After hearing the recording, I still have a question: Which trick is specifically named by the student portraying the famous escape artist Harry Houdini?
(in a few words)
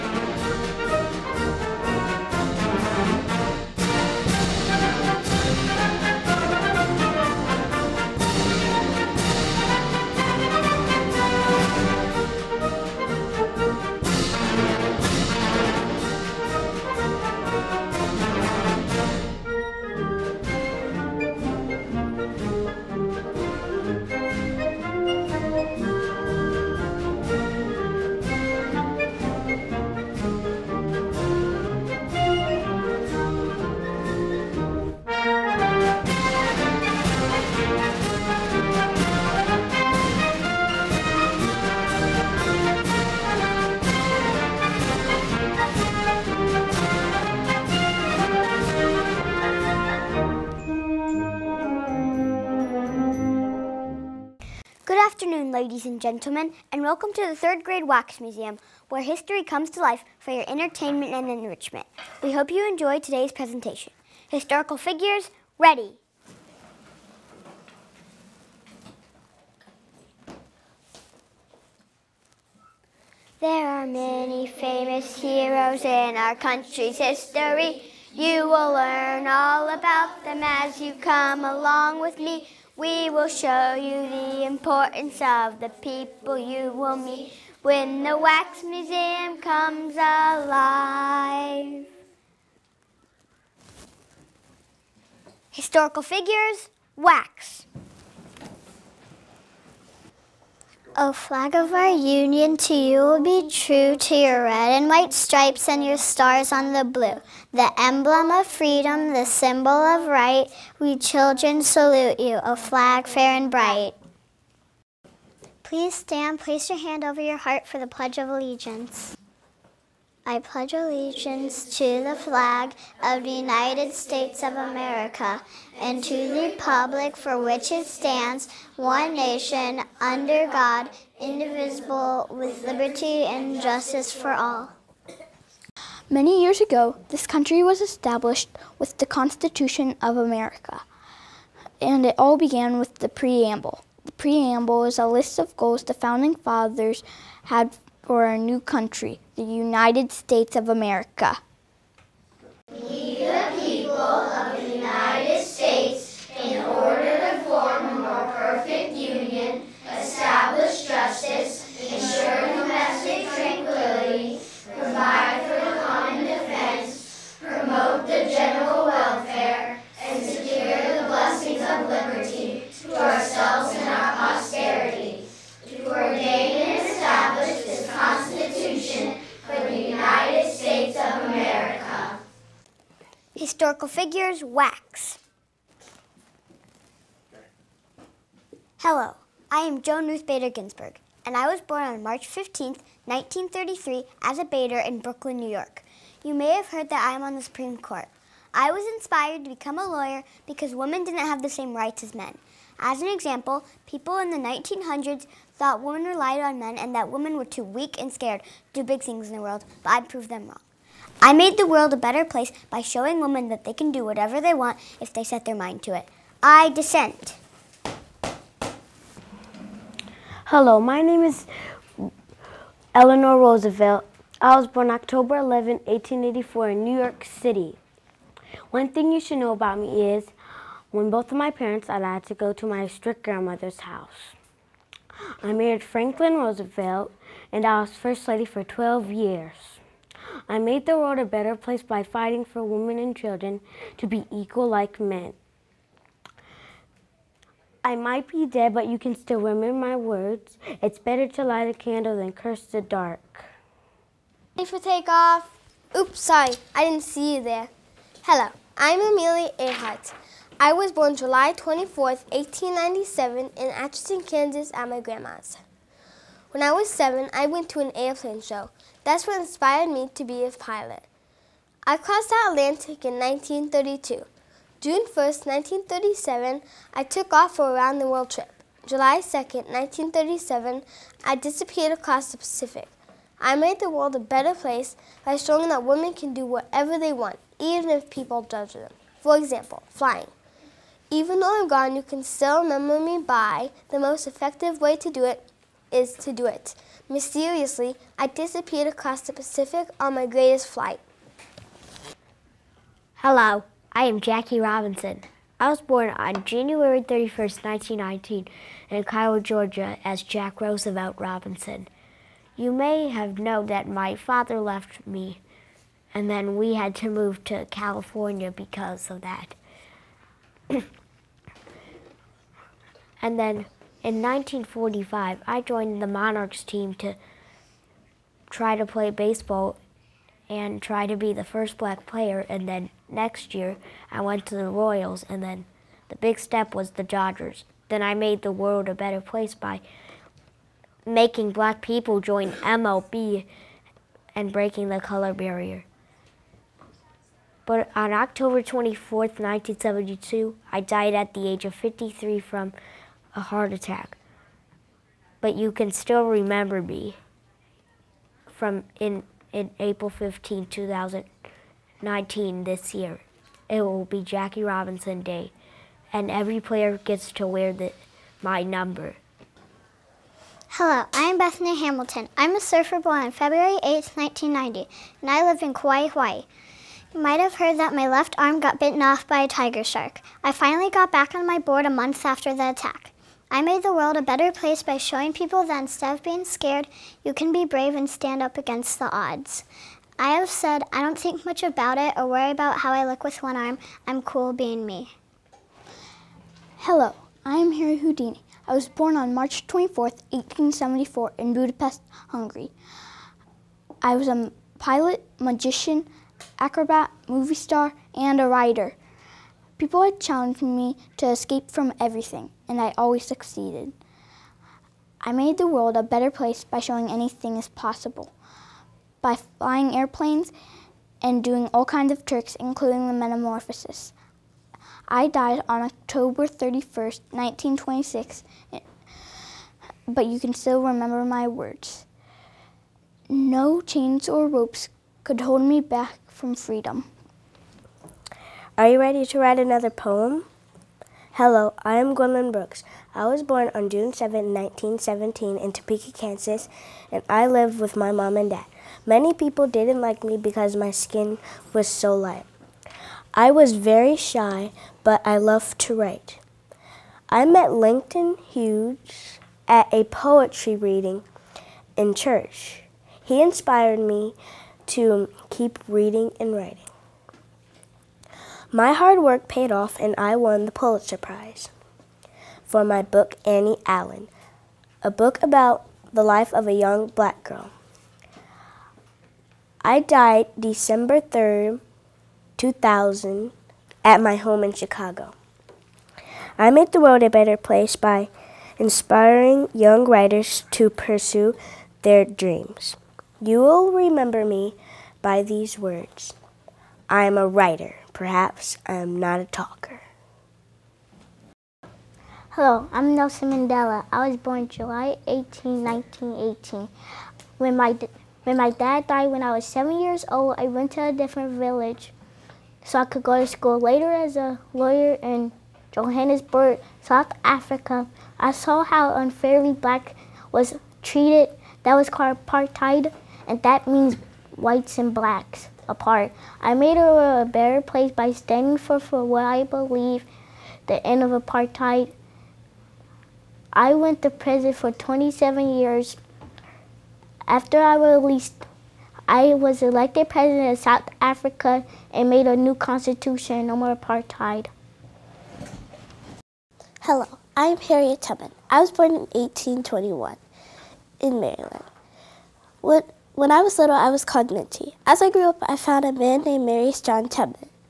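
the metamorphosis.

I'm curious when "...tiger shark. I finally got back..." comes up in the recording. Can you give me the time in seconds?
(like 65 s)
379 s.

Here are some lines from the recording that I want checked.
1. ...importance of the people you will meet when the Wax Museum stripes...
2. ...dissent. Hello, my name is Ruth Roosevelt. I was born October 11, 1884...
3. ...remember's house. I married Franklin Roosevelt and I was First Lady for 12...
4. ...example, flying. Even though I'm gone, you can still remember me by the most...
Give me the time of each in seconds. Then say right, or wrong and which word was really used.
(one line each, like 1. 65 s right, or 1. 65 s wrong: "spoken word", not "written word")
1. 84 s wrong: "comes", not "stripes"
2. 216 s wrong: "Eleanor", not "Ruth"
3. 233 s wrong: "grandmother", not "remember"
4. 289 s right.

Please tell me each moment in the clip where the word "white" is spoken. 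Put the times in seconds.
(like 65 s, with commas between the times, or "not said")
104 s, 524 s.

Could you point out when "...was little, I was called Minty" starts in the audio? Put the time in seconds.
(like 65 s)
553 s.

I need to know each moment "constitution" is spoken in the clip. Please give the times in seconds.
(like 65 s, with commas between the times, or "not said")
139 s, 542 s.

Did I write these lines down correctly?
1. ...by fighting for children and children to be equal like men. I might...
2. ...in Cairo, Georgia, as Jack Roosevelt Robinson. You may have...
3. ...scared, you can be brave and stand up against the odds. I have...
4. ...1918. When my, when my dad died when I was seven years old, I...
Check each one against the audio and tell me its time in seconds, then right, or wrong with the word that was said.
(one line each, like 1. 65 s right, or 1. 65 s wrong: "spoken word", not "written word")
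1. 241 s wrong: "women", not "children"
2. 308 s right
3. 386 s right
4. 505 s right.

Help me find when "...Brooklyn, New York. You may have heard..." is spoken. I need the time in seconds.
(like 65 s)
195 s.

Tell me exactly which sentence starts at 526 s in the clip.
I made a better place by standing for, for what I believe, the end of apartheid.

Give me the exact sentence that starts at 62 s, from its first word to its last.
We hope you enjoy today's presentation.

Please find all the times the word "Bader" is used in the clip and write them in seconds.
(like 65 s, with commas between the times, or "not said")
190 s, 194 s.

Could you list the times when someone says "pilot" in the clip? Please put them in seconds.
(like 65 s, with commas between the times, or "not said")
270 s, 404 s.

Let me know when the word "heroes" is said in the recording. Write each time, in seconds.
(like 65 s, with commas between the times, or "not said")
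75 s.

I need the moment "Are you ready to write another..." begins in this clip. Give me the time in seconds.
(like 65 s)
438 s.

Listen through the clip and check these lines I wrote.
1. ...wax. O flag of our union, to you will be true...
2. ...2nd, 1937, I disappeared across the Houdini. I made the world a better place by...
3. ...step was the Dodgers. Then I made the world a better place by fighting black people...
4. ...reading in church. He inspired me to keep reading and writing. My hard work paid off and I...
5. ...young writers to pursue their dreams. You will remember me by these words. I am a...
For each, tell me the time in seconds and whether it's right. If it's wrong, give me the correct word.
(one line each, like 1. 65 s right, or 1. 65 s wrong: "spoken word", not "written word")
1. 96 s right
2. 279 s wrong: "Pacific", not "Houdini"
3. 336 s wrong: "making", not "fighting"
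4. 460 s right
5. 489 s right.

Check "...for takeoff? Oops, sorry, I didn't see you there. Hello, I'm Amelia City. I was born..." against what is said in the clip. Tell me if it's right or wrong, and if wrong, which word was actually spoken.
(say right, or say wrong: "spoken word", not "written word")
wrong: "Earhart", not "City".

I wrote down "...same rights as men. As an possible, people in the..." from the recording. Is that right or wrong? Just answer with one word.
wrong.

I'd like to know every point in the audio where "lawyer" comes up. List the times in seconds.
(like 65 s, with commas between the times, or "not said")
199 s, 514 s.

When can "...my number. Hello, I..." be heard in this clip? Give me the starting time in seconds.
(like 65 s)
368 s.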